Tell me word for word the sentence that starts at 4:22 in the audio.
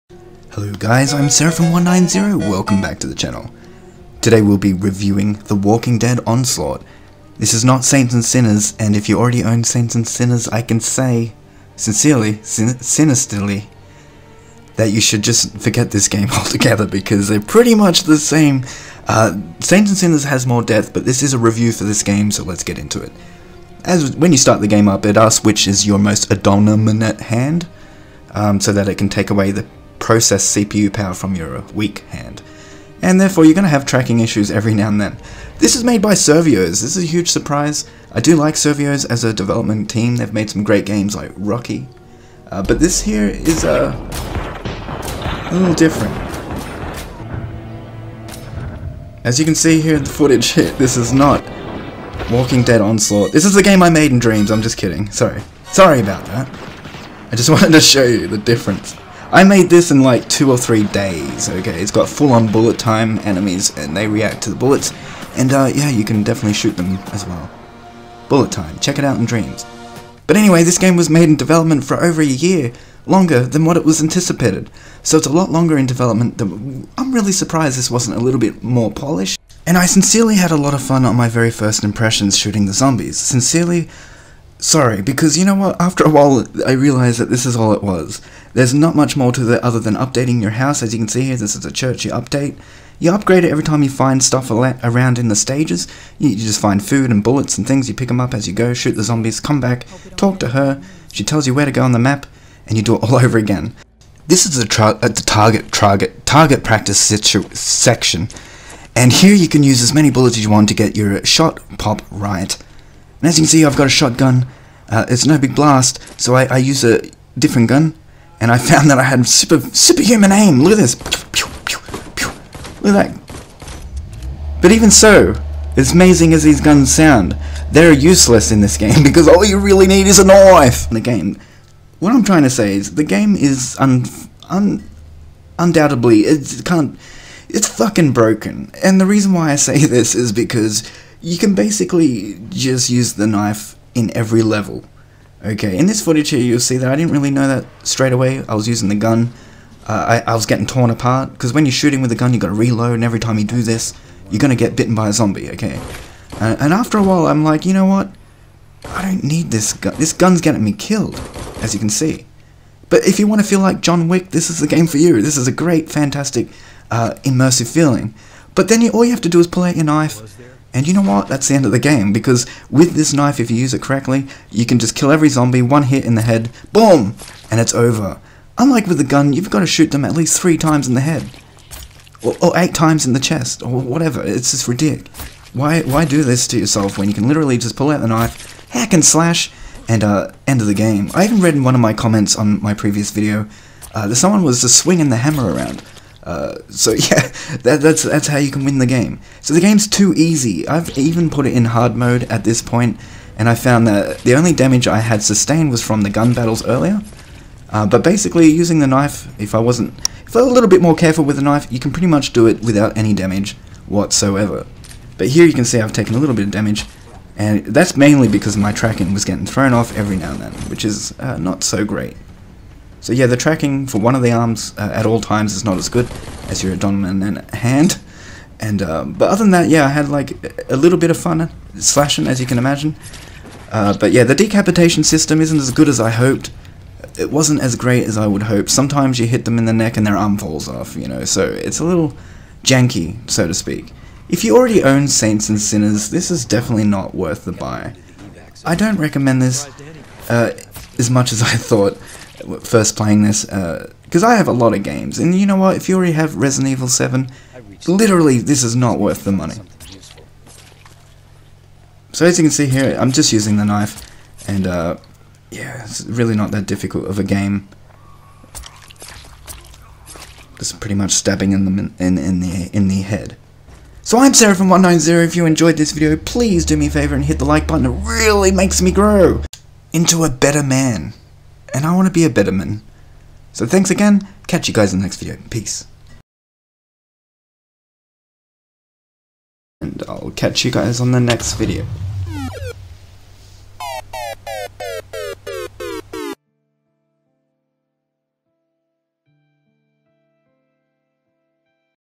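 So as you can see here, I'm just using the knife, and uh, yeah, it's really not that difficult of a game.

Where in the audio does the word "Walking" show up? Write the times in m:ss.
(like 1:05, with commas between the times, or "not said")
0:05, 0:52.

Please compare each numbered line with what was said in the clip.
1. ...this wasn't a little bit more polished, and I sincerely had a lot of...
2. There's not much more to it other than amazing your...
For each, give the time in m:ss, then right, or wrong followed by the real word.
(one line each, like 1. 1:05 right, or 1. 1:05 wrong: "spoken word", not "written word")
1. 1:17 right
2. 1:28 wrong: "updating", not "amazing".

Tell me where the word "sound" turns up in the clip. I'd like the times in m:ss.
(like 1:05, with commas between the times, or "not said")
2:06.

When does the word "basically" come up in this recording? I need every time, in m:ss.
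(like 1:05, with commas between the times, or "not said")
2:21, 3:28.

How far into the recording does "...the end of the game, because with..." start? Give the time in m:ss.
2:51.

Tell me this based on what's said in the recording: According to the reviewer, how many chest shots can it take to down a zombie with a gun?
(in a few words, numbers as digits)
8.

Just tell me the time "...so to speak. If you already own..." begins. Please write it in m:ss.
4:03.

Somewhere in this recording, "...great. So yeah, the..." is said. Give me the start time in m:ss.
3:41.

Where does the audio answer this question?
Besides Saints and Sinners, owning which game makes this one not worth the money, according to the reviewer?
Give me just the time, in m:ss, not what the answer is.
4:16.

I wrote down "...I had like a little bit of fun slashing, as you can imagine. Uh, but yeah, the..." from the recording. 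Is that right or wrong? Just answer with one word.
right.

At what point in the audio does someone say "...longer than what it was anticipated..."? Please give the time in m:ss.
1:13.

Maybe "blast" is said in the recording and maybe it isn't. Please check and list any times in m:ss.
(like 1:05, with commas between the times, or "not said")
1:55.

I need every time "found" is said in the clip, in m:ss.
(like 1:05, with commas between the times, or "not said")
1:58, 3:23.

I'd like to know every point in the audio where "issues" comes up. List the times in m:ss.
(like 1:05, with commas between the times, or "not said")
0:34.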